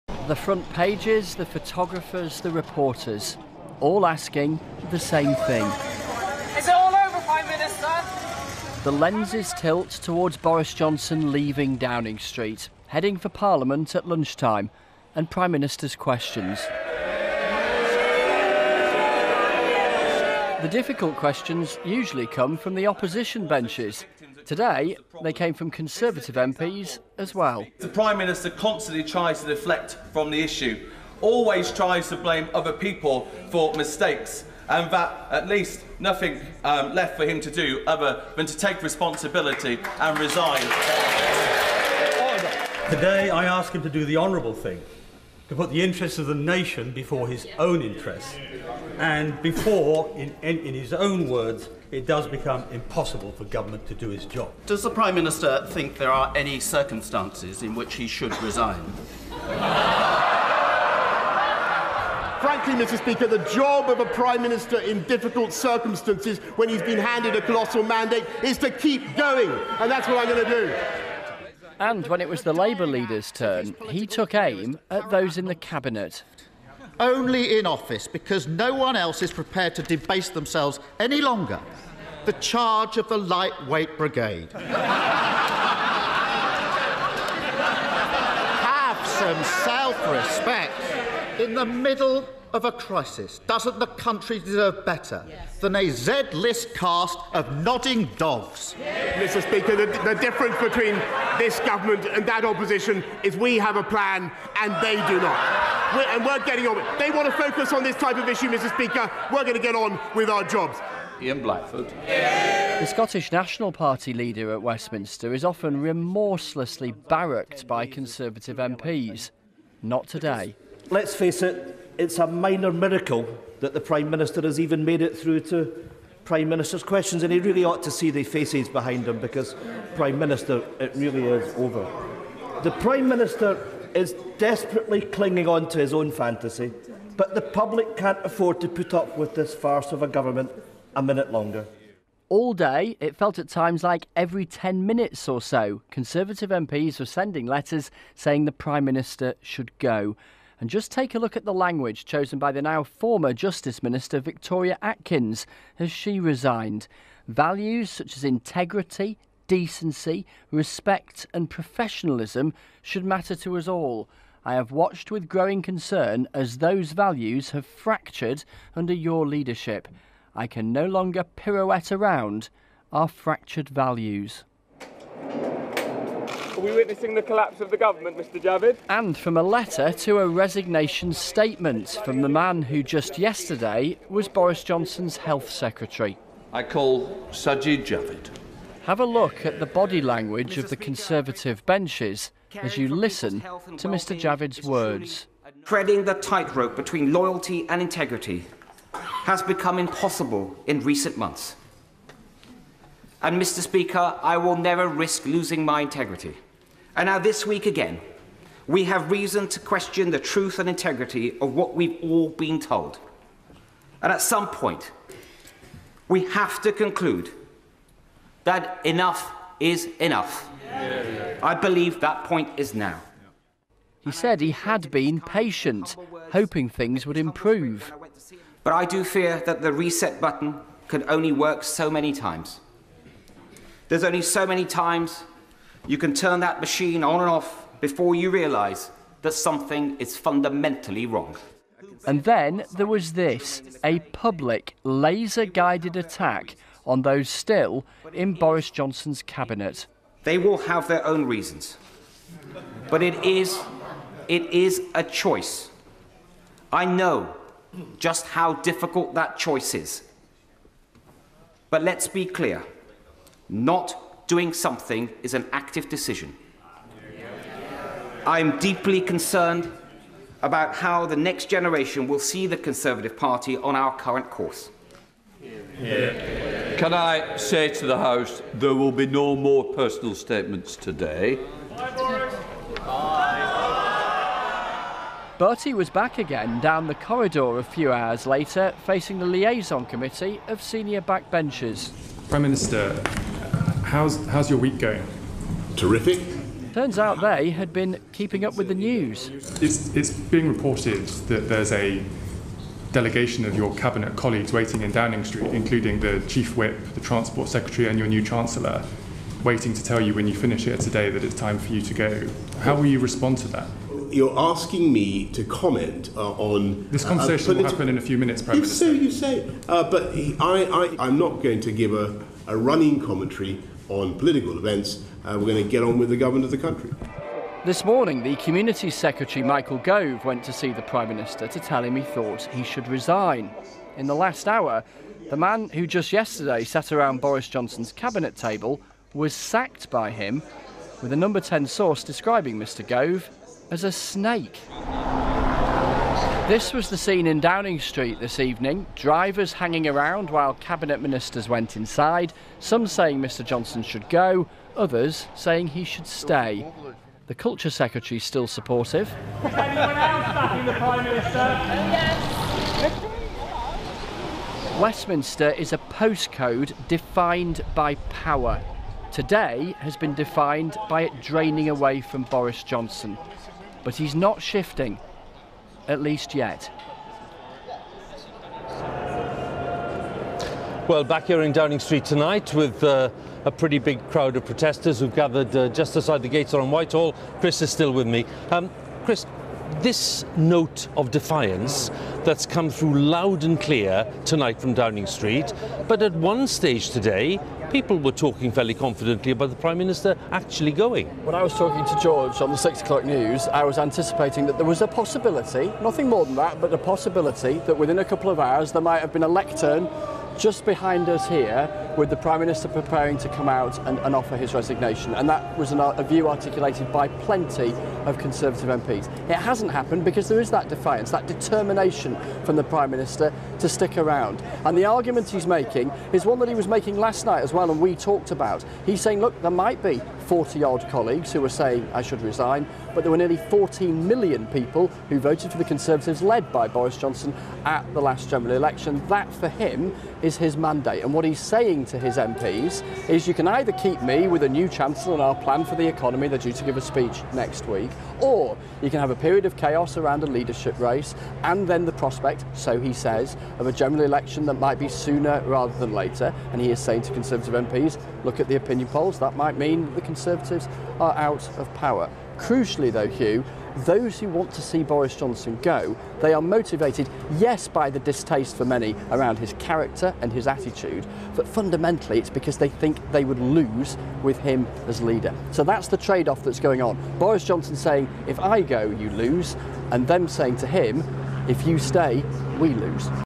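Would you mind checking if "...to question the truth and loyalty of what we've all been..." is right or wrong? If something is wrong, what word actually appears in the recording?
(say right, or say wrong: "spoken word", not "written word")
wrong: "integrity", not "loyalty".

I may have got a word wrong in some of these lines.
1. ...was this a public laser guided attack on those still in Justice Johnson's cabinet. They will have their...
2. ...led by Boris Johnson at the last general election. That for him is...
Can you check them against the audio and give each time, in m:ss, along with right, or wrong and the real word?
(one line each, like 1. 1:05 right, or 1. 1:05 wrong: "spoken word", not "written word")
1. 4:02 wrong: "Boris", not "Justice"
2. 7:16 right.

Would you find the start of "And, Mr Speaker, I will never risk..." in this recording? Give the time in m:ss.
3:23.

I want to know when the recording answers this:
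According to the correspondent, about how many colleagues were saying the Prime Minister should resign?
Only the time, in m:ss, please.
7:10.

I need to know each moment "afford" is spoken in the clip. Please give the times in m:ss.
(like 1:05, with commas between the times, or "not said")
2:18.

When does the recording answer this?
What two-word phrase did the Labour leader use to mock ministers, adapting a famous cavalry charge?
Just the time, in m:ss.
1:23.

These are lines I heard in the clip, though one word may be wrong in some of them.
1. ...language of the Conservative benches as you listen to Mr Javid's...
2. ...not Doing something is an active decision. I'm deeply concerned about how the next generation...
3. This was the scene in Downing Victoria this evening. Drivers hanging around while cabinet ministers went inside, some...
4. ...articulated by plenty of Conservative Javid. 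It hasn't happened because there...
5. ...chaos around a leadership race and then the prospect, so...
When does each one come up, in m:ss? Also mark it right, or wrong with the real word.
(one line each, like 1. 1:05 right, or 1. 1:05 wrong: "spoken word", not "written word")
1. 3:10 right
2. 4:23 right
3. 5:46 wrong: "Street", not "Victoria"
4. 6:56 wrong: "MPs", not "Javid"
5. 7:29 right.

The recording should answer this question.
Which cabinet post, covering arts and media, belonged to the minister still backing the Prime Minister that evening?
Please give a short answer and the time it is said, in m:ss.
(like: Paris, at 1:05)
The culture secretary, at 5:57.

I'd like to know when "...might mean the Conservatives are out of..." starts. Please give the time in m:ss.
7:39.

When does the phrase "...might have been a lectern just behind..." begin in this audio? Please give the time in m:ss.
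6:48.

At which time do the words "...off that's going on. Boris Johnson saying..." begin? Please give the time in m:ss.
7:56.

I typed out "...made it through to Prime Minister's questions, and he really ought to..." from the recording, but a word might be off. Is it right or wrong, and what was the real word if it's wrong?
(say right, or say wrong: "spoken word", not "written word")
right.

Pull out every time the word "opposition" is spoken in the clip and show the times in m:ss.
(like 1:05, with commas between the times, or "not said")
0:22, 1:42.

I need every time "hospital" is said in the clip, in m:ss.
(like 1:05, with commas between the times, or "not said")
not said.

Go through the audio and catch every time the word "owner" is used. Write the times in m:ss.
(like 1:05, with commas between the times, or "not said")
not said.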